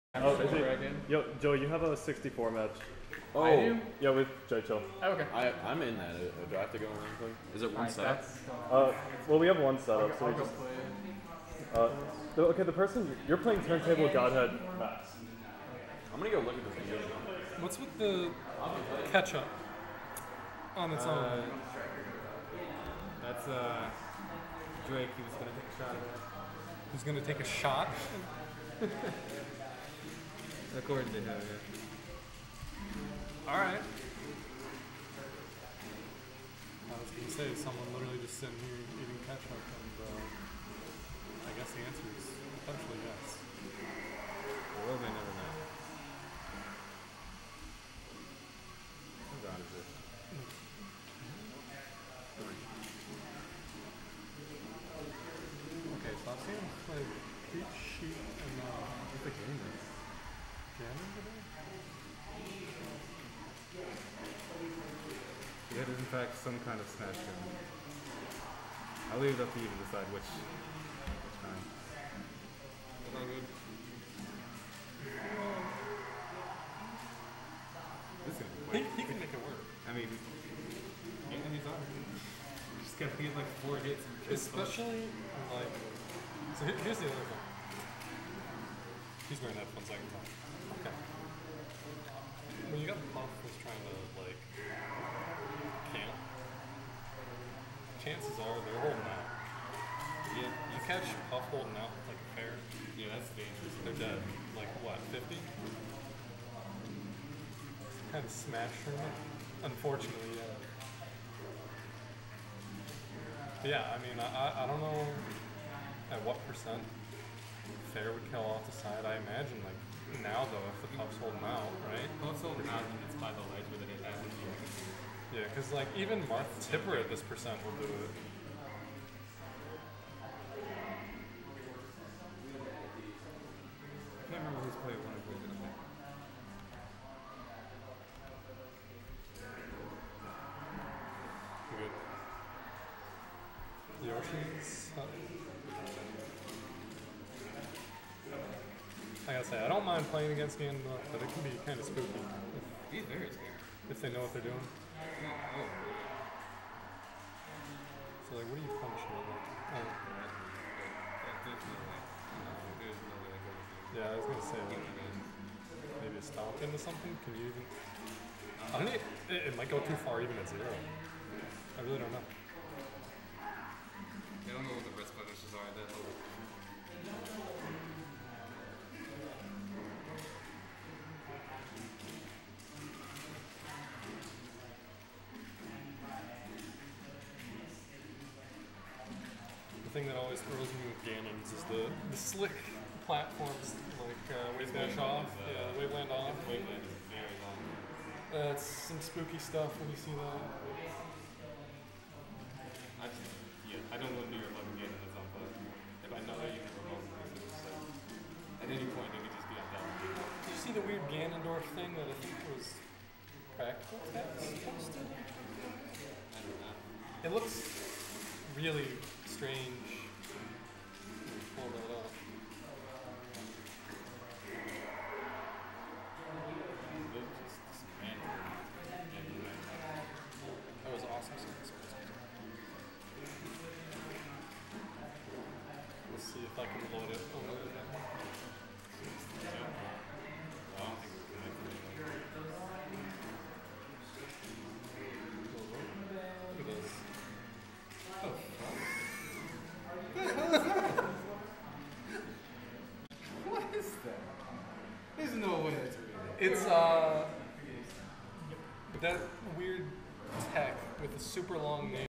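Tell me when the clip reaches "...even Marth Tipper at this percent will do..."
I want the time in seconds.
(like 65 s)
125 s.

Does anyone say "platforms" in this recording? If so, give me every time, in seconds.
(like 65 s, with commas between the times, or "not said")
193 s.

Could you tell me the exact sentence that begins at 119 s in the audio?
Like now though, if the Puff's holding out, right?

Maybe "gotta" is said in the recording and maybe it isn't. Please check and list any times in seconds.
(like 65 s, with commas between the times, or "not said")
82 s, 149 s.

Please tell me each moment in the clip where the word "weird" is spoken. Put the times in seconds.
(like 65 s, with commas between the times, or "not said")
210 s, 259 s.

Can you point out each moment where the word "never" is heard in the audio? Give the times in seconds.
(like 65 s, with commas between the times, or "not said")
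45 s, 206 s.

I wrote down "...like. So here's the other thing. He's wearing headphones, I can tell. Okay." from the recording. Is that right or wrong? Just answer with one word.
right.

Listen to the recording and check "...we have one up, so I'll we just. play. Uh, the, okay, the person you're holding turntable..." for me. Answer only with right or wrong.
wrong.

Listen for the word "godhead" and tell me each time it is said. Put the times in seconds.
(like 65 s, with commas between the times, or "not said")
14 s.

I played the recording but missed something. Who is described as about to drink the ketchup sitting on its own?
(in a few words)
Drake.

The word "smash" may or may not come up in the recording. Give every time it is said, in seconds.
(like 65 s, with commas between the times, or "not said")
66 s, 108 s.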